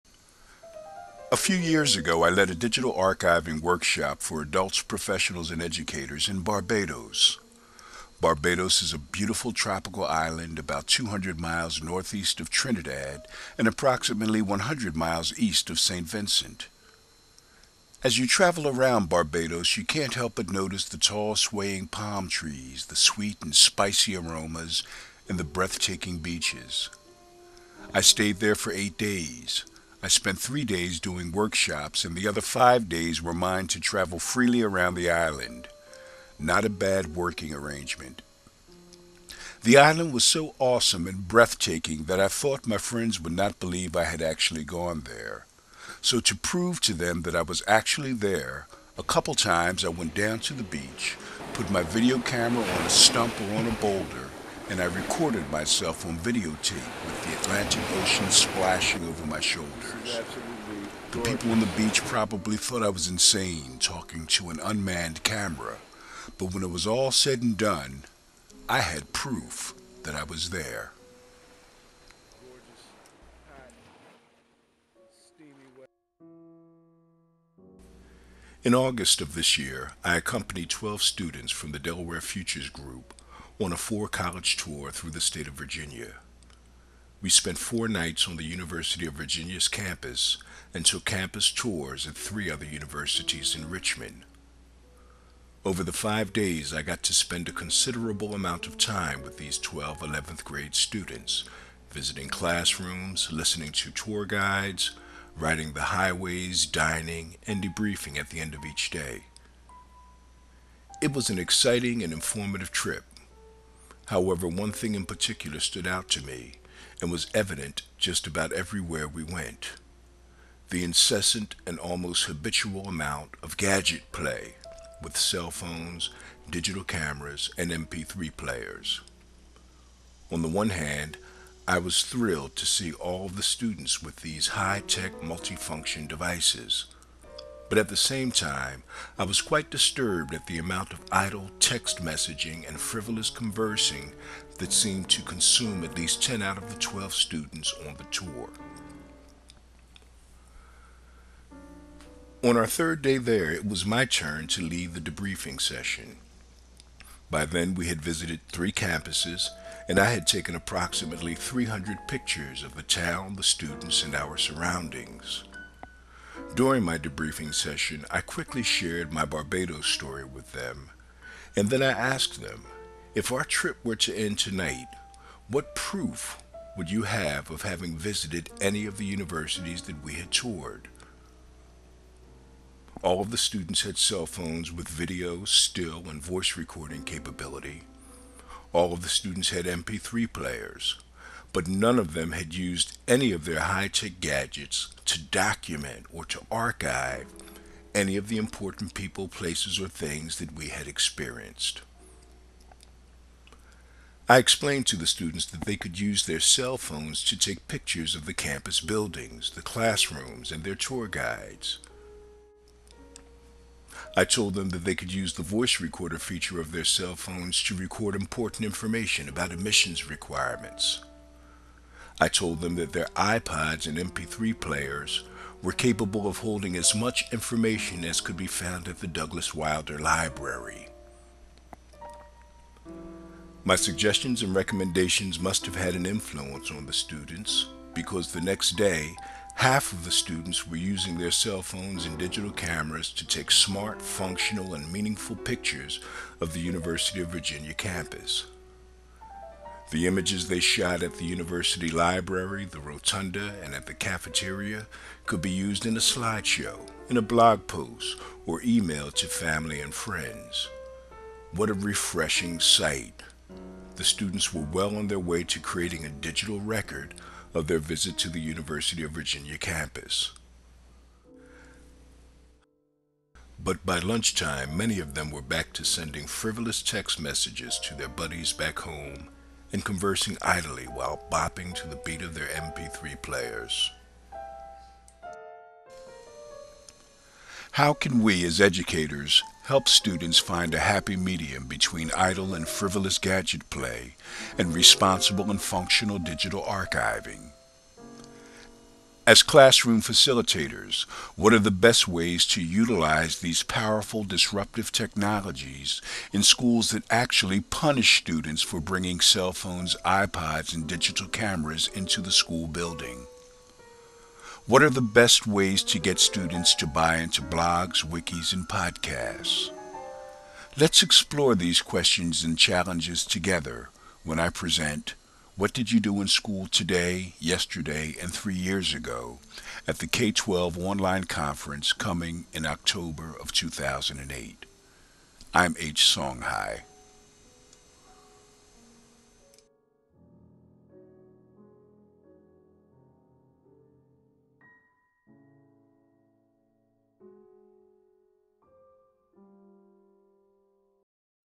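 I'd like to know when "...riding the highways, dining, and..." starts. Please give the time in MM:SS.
01:45.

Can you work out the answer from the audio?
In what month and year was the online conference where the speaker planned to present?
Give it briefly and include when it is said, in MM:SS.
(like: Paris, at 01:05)
October 2008, at 05:32.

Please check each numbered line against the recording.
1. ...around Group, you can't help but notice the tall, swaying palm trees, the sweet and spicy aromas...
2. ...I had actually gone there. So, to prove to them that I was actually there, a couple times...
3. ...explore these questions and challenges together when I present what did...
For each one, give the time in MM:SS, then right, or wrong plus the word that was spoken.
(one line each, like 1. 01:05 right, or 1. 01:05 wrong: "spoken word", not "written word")
1. 00:18 wrong: "Barbados", not "Group"
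2. 00:43 right
3. 05:21 right.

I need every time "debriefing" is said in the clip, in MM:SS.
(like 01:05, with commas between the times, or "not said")
01:47, 02:34, 02:46.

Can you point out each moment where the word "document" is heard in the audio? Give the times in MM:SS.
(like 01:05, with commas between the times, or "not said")
03:15.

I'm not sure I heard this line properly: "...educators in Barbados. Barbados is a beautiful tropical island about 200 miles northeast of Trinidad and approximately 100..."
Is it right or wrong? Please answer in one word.
right.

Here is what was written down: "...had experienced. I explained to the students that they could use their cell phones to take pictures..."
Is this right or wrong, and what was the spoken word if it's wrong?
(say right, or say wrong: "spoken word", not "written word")
right.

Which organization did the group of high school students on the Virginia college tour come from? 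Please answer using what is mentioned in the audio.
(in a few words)
Delaware Futures Group.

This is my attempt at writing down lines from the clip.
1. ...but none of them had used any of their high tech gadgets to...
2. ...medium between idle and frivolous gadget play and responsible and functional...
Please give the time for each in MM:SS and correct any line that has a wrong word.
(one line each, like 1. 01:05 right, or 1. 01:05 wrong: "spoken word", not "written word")
1. 03:11 right
2. 04:51 right.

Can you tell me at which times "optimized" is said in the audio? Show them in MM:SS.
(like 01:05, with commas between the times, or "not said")
not said.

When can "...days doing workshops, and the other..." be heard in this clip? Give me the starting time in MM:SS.
00:30.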